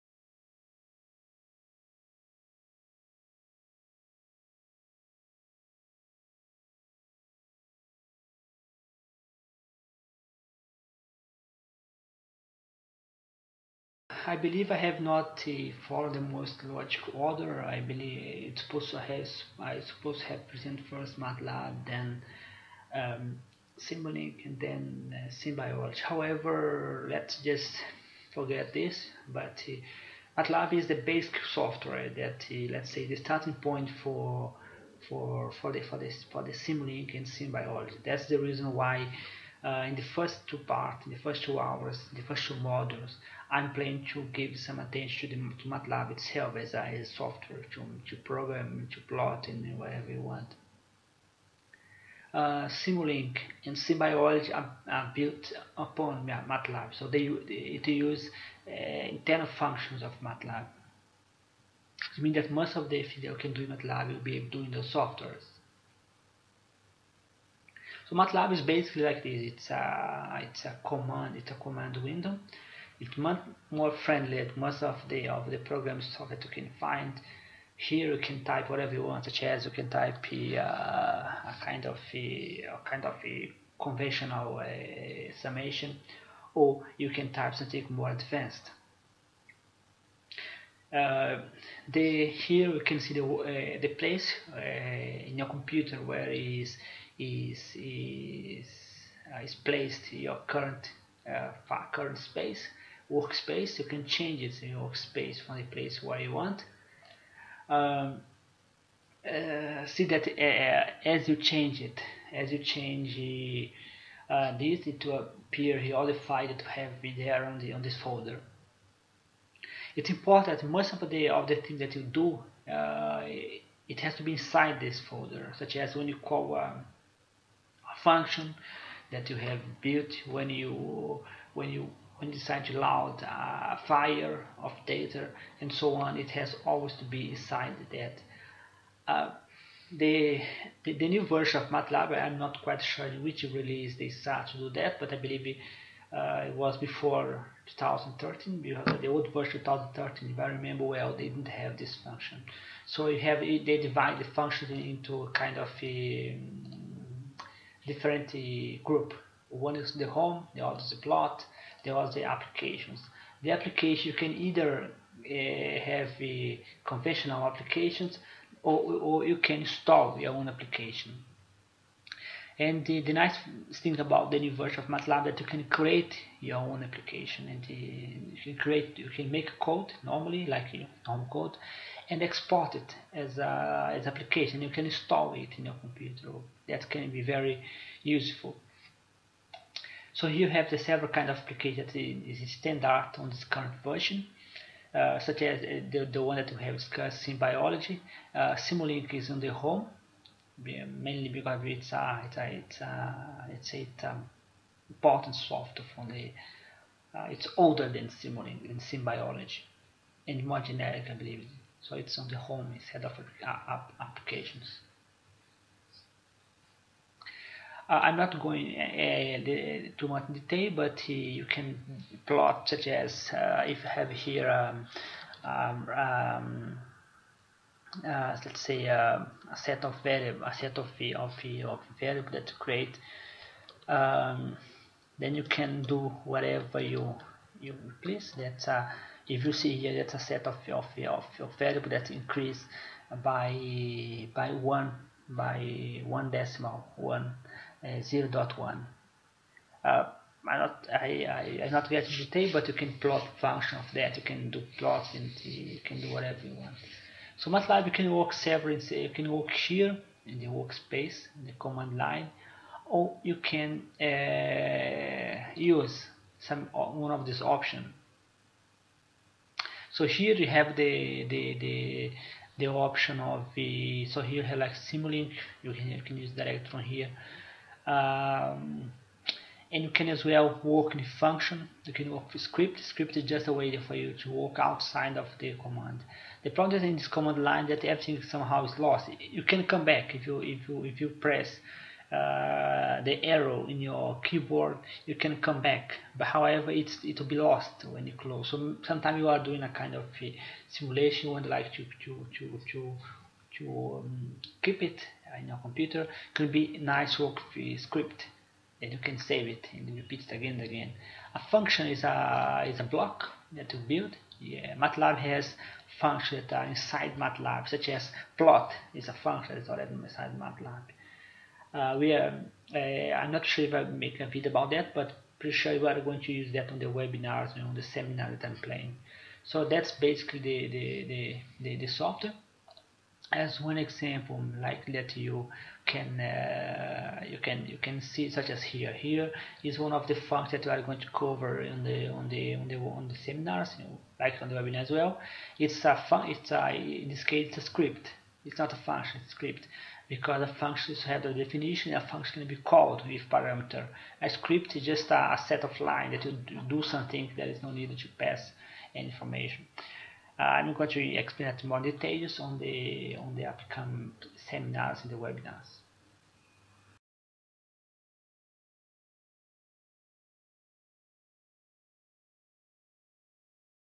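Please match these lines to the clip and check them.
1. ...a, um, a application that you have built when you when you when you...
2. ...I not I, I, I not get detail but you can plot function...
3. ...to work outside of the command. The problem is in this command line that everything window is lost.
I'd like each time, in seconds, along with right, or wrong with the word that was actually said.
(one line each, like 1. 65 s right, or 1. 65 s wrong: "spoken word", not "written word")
1. 126 s wrong: "function", not "application"
2. 250 s right
3. 284 s wrong: "somehow", not "window".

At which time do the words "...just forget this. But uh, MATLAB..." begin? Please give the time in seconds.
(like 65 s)
27 s.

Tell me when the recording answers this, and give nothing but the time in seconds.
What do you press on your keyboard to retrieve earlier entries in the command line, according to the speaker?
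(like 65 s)
293 s.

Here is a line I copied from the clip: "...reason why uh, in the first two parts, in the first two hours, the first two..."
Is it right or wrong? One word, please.
right.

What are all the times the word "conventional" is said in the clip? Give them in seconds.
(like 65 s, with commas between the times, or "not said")
83 s, 166 s.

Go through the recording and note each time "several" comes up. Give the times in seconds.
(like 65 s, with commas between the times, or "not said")
190 s, 258 s.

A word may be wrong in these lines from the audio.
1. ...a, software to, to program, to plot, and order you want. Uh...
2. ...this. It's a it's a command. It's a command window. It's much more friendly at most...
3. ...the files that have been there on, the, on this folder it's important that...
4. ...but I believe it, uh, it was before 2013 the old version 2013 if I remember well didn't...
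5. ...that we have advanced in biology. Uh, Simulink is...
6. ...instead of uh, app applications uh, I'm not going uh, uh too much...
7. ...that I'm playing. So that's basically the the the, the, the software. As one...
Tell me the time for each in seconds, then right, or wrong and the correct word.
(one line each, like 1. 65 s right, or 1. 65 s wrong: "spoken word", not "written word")
1. 46 s wrong: "whatever", not "order"
2. 69 s right
3. 116 s right
4. 144 s right
5. 196 s wrong: "discussed", not "advanced"
6. 212 s right
7. 328 s right.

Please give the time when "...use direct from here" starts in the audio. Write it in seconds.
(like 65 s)
276 s.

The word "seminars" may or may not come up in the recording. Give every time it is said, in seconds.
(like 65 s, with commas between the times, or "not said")
327 s, 343 s, 364 s.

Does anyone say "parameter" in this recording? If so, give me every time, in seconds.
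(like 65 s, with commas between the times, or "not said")
353 s.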